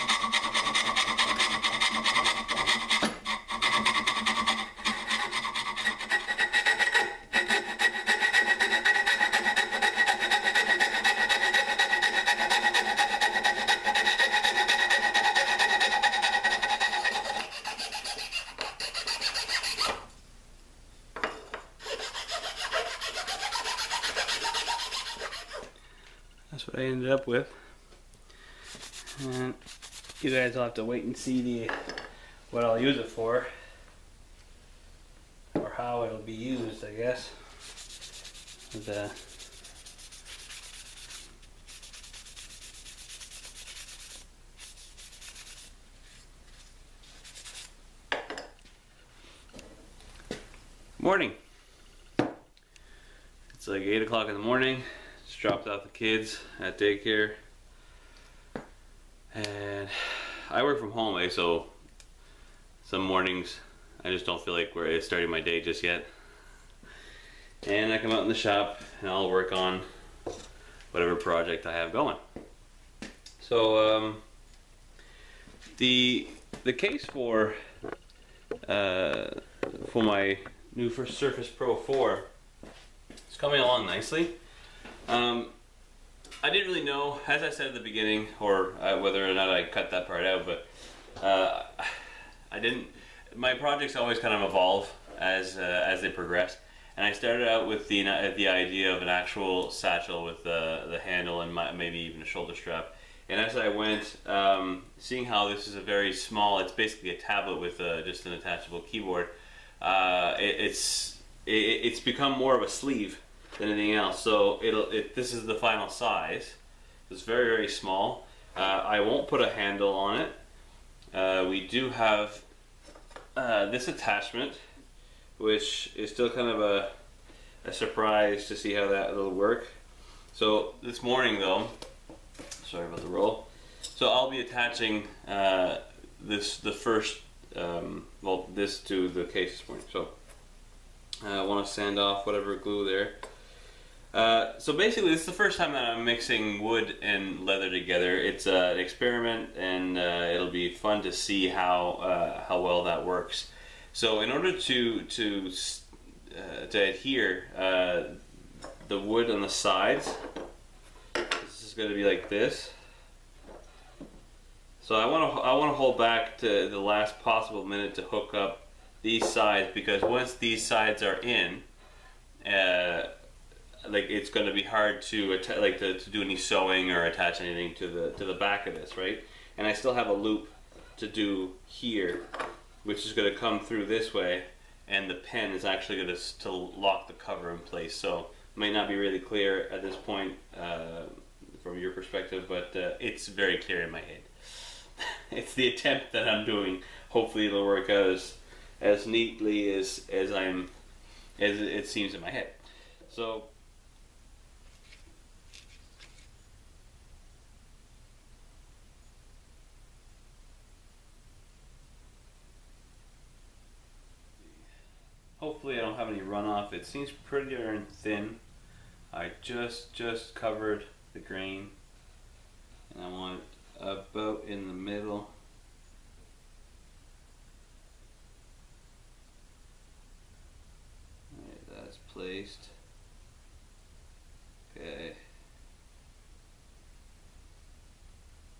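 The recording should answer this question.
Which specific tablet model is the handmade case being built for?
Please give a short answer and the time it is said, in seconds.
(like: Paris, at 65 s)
Surface Pro 4, at 80 s.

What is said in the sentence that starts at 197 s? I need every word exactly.
Hopefully, it'll work out as as neatly as as I'm as it seems in my head.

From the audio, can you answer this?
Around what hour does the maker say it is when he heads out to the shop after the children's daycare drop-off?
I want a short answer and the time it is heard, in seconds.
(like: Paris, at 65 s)
8 o'clock, at 53 s.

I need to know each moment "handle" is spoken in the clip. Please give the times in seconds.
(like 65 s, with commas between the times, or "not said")
100 s, 119 s.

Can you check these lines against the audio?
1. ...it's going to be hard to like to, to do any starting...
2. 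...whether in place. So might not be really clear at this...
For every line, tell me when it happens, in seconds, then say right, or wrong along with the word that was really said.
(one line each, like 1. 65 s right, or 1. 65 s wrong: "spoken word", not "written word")
1. 174 s wrong: "sewing", not "starting"
2. 187 s wrong: "cover", not "whether".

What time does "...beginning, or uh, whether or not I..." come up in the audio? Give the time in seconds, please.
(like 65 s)
87 s.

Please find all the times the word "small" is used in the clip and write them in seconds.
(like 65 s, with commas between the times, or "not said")
106 s, 117 s.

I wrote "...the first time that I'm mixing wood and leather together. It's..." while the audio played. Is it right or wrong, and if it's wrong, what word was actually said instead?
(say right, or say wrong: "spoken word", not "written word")
right.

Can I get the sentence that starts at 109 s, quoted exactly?
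Uh, it, it's it, it's become more of a sleeve than anything else.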